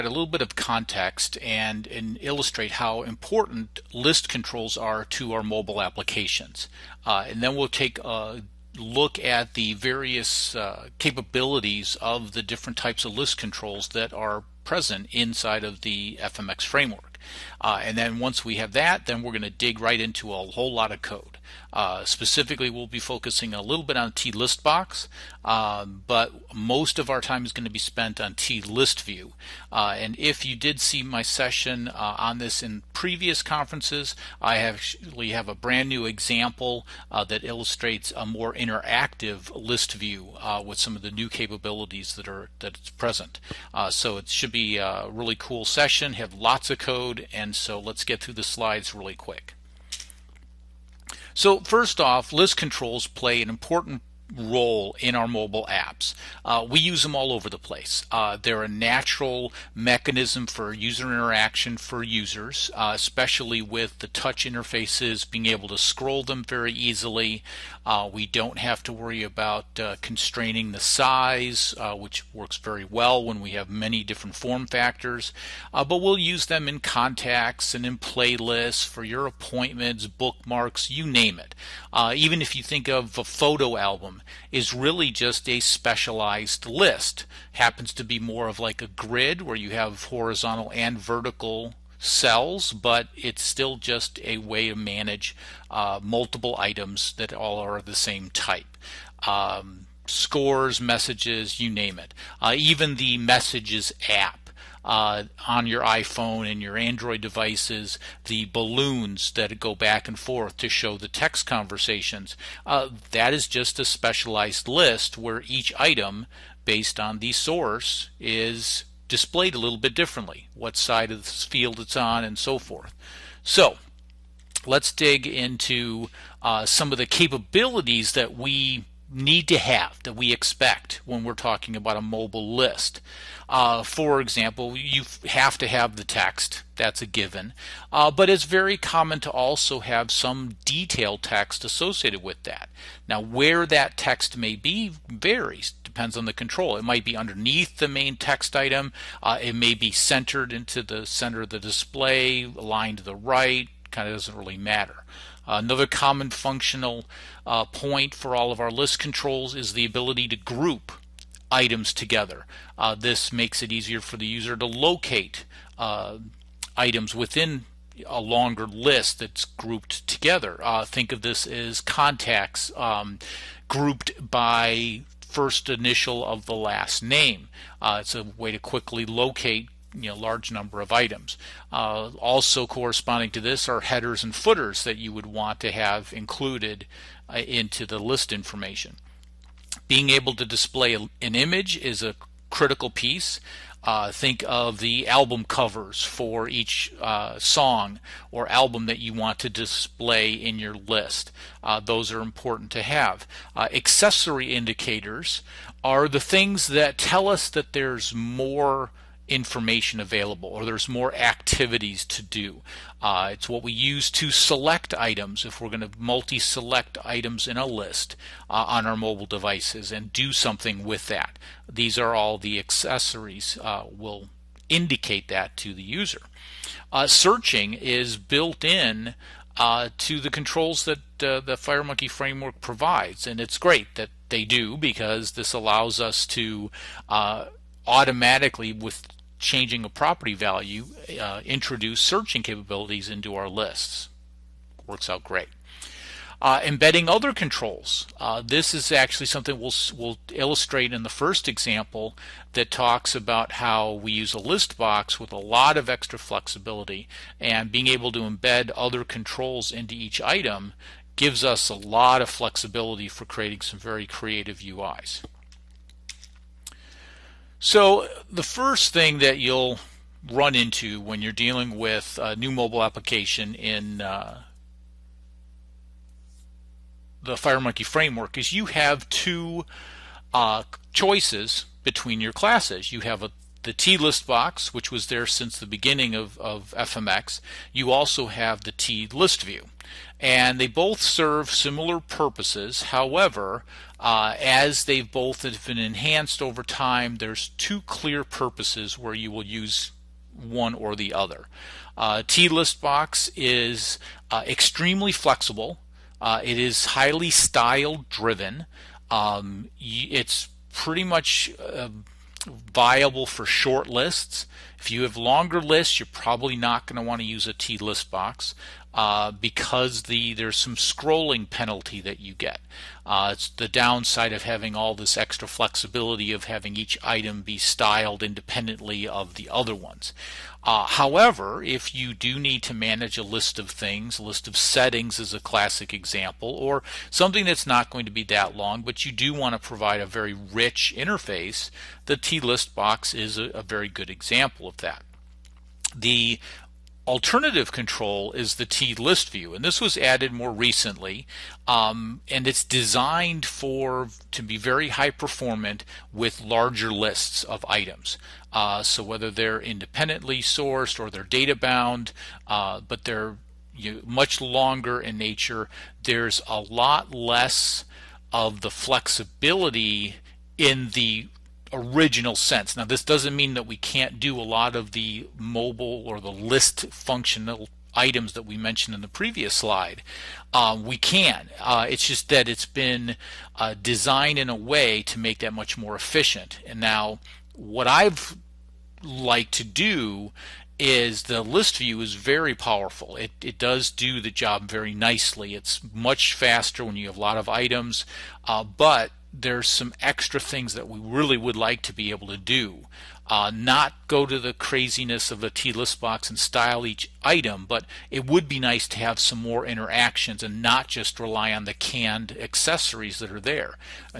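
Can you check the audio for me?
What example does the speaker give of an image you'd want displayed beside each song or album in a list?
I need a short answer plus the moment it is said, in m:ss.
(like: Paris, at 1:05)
Album covers, at 3:15.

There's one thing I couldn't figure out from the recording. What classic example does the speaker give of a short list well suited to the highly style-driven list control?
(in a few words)
A list of settings.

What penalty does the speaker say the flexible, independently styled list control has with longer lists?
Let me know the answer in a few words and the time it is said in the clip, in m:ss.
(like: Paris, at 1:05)
Scrolling penalty, at 5:20.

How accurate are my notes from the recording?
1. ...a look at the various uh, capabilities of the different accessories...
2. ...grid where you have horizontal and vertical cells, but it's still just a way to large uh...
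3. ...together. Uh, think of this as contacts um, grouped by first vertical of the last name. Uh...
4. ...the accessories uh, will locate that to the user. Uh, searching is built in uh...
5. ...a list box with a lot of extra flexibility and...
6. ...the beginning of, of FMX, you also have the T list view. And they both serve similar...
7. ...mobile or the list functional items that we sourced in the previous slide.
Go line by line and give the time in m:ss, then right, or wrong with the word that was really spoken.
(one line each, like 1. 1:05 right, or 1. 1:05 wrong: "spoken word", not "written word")
1. 0:08 wrong: "types", not "accessories"
2. 1:28 wrong: "manage", not "large"
3. 2:50 wrong: "initial", not "vertical"
4. 3:42 wrong: "indicate", not "locate"
5. 4:14 right
6. 4:45 right
7. 6:15 wrong: "mentioned", not "sourced".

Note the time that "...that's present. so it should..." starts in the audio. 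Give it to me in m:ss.
0:42.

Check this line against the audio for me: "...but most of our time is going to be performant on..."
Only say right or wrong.
wrong.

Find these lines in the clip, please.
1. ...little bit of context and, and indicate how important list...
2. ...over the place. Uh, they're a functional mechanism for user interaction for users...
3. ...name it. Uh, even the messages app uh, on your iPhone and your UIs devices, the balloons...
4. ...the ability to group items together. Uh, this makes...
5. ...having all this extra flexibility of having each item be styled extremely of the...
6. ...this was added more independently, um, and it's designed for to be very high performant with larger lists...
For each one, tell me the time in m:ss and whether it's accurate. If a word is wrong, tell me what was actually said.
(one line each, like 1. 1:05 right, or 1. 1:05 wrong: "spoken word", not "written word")
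1. 0:00 wrong: "illustrate", not "indicate"
2. 0:57 wrong: "natural", not "functional"
3. 1:41 wrong: "Android", not "UIs"
4. 2:39 right
5. 5:24 wrong: "independently", not "extremely"
6. 5:49 wrong: "recently", not "independently".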